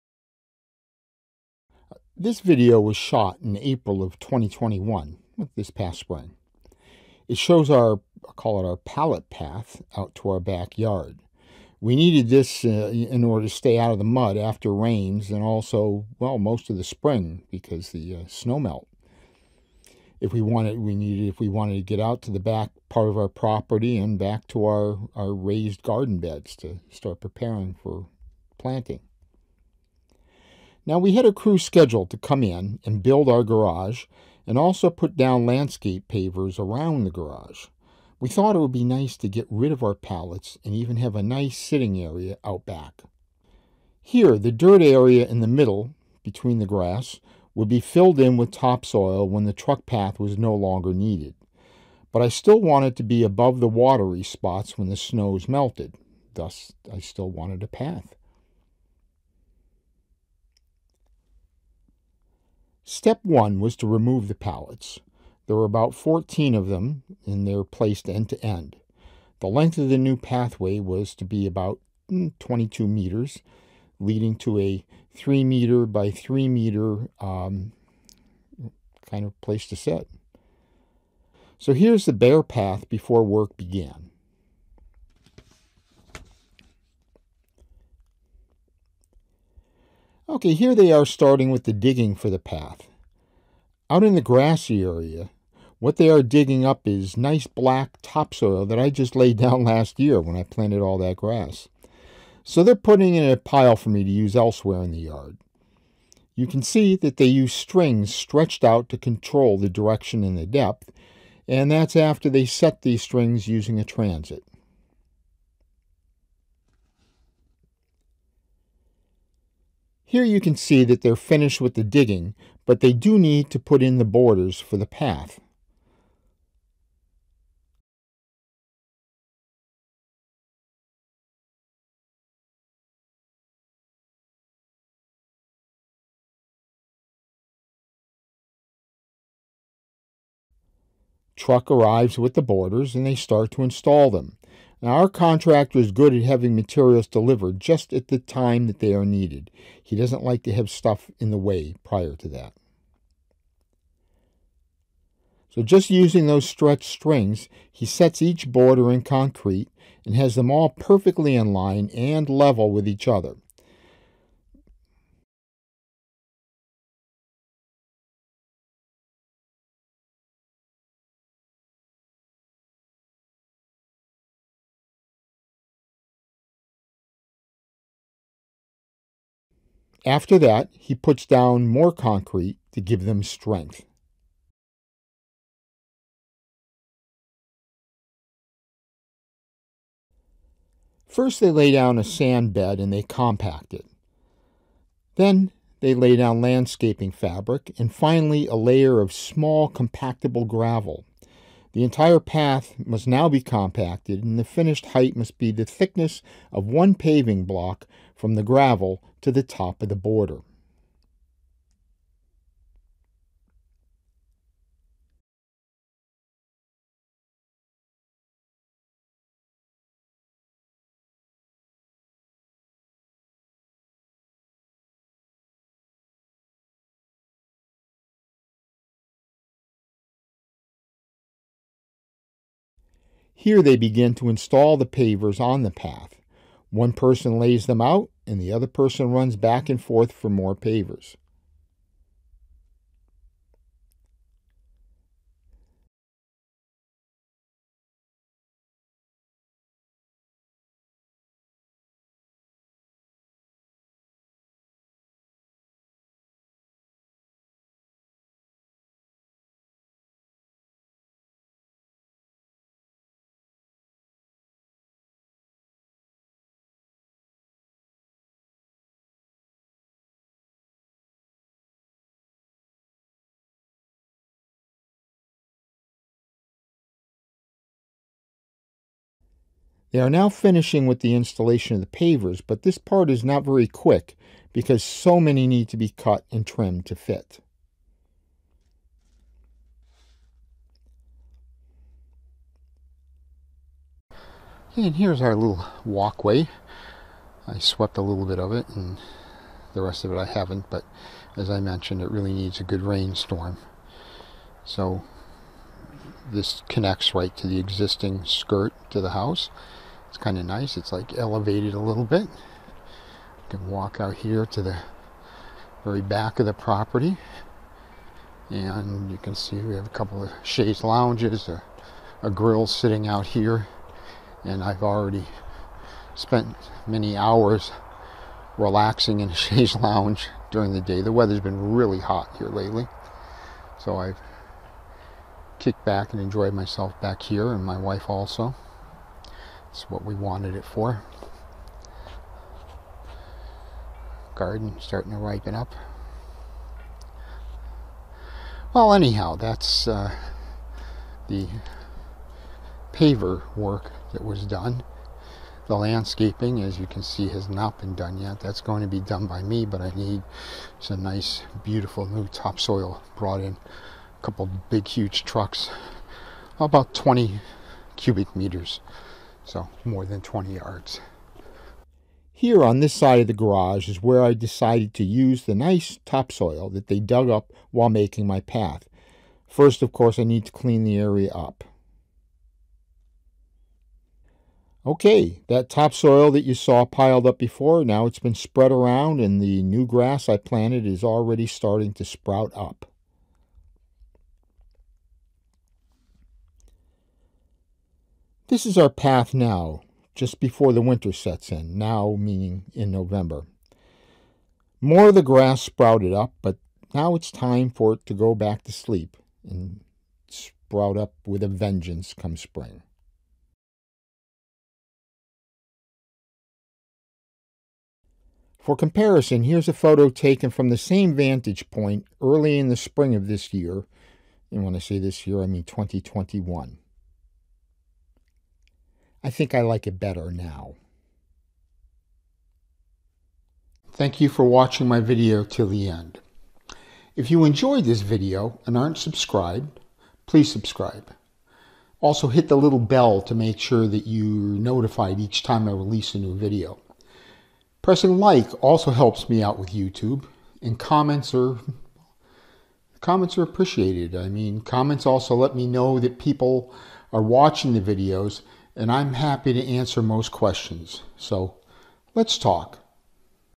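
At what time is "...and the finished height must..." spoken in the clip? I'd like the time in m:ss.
3:24.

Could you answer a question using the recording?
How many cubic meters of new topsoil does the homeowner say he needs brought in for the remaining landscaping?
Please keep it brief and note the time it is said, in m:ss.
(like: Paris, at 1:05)
20 cubic meters, at 6:06.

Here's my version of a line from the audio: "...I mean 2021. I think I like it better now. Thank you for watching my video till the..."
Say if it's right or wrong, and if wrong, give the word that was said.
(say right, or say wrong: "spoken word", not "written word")
right.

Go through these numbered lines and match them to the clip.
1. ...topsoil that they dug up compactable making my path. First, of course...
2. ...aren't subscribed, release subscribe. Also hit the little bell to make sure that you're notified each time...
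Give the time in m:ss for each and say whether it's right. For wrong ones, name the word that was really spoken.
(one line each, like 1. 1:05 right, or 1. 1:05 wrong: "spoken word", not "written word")
1. 6:16 wrong: "while", not "compactable"
2. 7:18 wrong: "please", not "release".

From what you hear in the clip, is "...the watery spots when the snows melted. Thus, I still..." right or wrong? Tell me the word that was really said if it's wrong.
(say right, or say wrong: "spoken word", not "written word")
right.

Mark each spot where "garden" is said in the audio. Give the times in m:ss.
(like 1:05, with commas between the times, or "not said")
0:25, 5:44.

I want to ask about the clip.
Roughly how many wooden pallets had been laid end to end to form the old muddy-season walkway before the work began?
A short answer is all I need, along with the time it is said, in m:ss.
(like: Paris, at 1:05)
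14, at 1:05.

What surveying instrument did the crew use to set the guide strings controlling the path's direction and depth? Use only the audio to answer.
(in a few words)
A transit.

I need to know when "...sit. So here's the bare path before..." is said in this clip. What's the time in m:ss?
1:19.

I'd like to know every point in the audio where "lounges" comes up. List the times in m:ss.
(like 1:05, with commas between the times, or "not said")
5:20, 5:29.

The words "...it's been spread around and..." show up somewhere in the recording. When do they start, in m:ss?
6:28.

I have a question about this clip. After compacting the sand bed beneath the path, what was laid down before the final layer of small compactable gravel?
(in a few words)
Landscaping fabric.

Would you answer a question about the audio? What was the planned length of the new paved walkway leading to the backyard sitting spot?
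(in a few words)
22 meters.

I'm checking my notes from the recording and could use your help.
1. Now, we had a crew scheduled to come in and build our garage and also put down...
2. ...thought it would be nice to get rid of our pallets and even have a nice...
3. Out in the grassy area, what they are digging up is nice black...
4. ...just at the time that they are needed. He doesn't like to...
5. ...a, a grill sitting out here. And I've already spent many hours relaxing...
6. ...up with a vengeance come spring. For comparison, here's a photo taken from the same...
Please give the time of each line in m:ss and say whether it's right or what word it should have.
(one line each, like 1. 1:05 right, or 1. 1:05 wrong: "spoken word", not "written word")
1. 0:30 right
2. 0:38 right
3. 1:33 right
4. 2:27 right
5. 5:21 right
6. 6:50 right.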